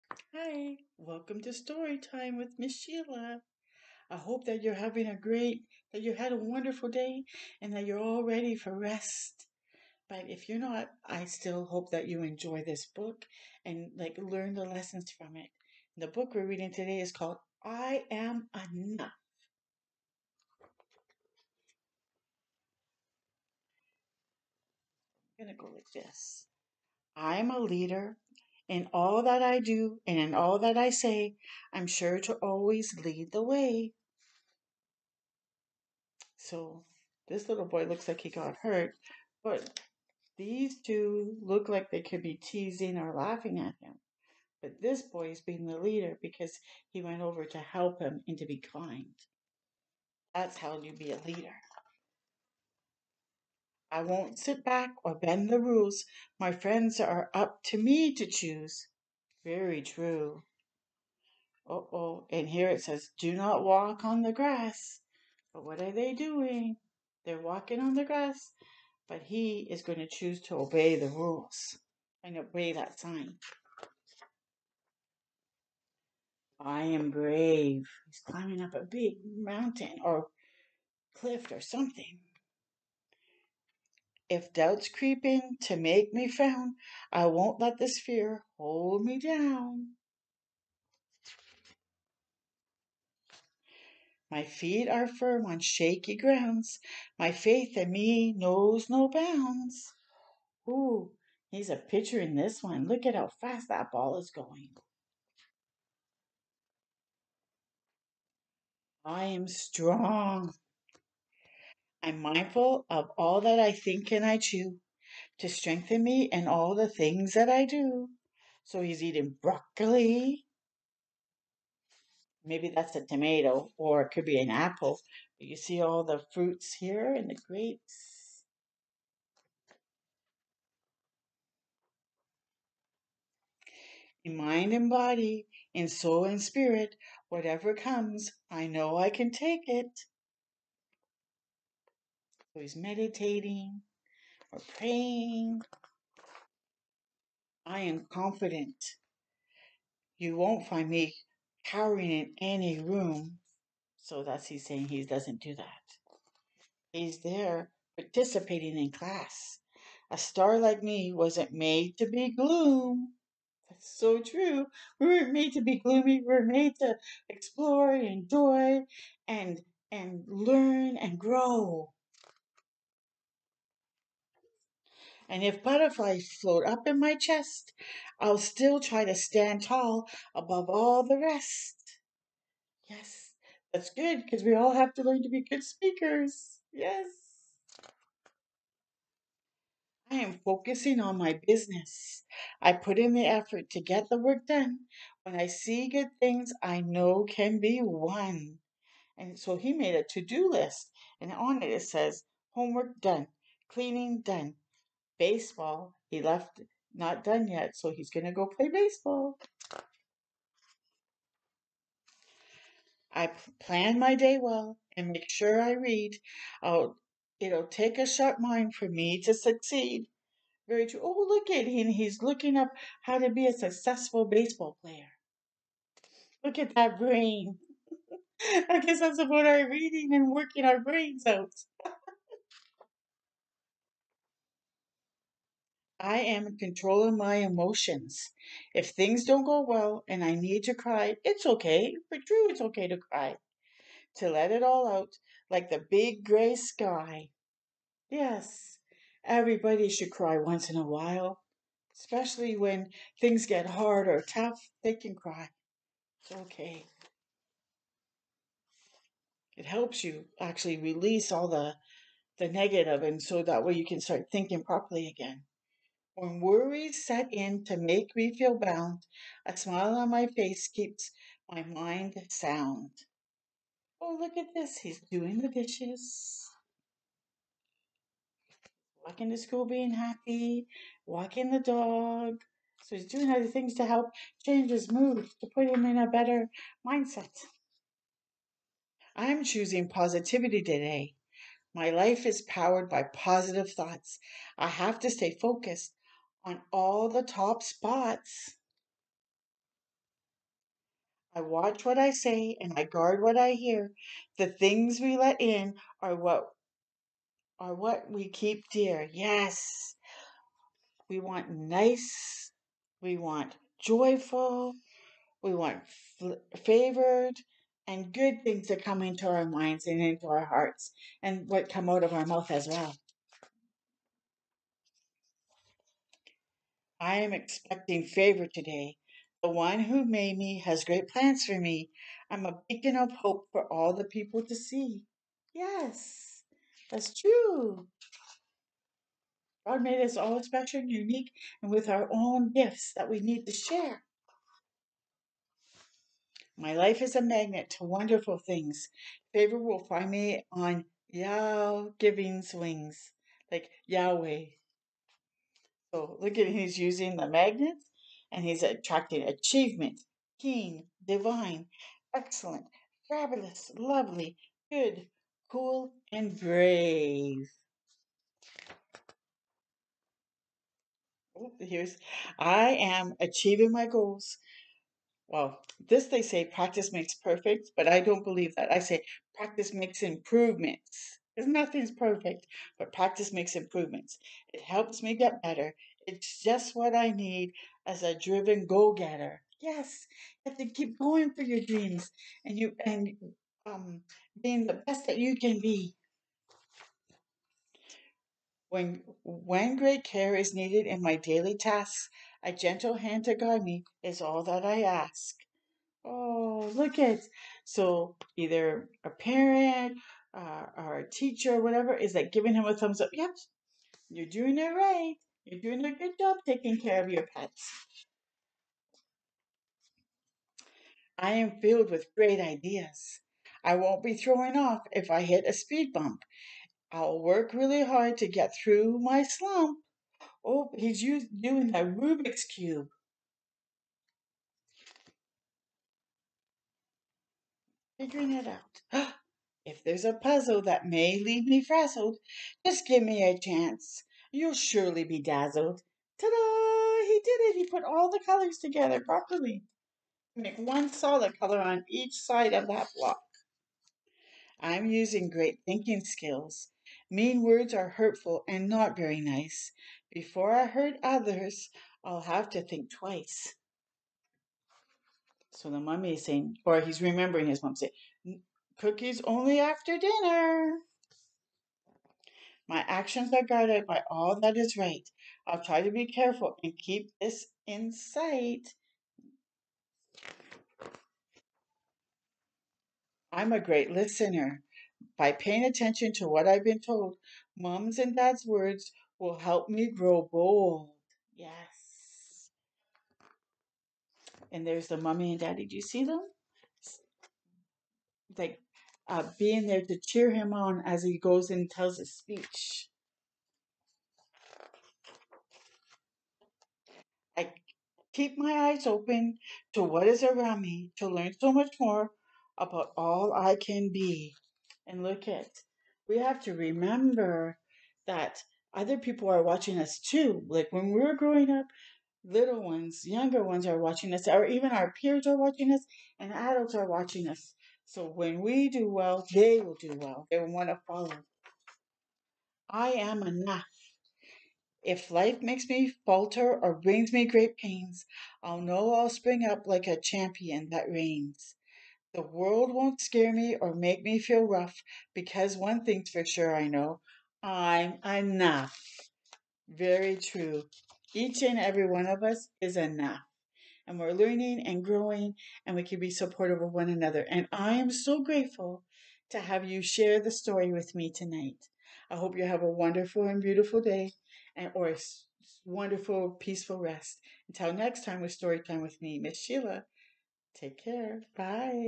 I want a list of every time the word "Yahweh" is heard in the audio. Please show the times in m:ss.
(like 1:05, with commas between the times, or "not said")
5:53.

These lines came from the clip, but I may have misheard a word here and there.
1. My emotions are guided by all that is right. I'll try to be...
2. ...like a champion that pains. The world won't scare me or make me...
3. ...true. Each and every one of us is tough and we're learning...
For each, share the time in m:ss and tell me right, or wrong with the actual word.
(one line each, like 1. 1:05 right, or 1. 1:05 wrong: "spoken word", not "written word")
1. 7:52 wrong: "actions", not "emotions"
2. 8:59 wrong: "reigns", not "pains"
3. 9:10 wrong: "enough", not "tough".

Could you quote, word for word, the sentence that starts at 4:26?
When worries set in to make me feel bound, a smile on my face keeps my mind sound.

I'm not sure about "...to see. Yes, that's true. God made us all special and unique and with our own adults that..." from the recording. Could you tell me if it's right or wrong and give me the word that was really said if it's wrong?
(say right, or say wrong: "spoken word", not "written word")
wrong: "gifts", not "adults".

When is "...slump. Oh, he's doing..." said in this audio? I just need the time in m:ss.
7:09.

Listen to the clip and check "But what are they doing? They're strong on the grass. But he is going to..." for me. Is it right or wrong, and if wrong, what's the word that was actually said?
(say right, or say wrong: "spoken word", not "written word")
wrong: "walking", not "strong".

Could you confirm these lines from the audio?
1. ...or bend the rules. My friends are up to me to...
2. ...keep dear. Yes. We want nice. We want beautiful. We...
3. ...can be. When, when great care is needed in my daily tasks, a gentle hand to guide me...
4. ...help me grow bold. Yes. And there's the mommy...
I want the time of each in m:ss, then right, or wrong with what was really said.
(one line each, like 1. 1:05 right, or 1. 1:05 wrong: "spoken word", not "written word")
1. 0:55 right
2. 5:08 wrong: "joyful", not "beautiful"
3. 6:35 right
4. 8:09 right.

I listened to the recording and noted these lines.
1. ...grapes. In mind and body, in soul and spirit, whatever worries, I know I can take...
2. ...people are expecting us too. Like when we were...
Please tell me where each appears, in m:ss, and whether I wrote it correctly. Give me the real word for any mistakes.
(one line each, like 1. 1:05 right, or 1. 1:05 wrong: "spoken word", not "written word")
1. 2:07 wrong: "comes", not "worries"
2. 8:38 wrong: "watching", not "expecting".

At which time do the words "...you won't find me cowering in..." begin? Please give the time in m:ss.
2:30.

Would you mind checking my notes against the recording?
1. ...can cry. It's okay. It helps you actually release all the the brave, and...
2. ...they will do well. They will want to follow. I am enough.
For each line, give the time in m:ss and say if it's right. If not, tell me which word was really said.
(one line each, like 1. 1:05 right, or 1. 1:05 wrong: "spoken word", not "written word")
1. 4:14 wrong: "negative", not "brave"
2. 8:49 right.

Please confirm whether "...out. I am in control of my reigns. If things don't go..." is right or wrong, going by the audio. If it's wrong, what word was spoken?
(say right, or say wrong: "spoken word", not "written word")
wrong: "emotions", not "reigns".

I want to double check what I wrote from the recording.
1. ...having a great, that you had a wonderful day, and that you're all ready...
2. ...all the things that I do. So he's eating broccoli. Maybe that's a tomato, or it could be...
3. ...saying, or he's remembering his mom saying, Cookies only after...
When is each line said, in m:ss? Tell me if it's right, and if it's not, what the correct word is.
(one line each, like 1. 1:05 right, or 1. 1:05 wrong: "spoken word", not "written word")
1. 0:04 right
2. 1:56 right
3. 7:46 right.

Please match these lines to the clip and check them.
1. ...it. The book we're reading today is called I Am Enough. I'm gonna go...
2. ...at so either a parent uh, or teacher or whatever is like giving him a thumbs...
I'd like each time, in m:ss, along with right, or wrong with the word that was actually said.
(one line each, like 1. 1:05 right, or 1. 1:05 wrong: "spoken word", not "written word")
1. 0:15 right
2. 6:46 right.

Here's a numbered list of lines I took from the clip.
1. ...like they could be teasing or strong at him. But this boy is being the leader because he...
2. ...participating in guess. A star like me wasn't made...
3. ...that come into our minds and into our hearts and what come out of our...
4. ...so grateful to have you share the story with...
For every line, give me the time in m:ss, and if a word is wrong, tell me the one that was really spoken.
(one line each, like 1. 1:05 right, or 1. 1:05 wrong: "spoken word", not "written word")
1. 0:41 wrong: "laughing", not "strong"
2. 2:37 wrong: "class", not "guess"
3. 5:18 right
4. 9:17 right.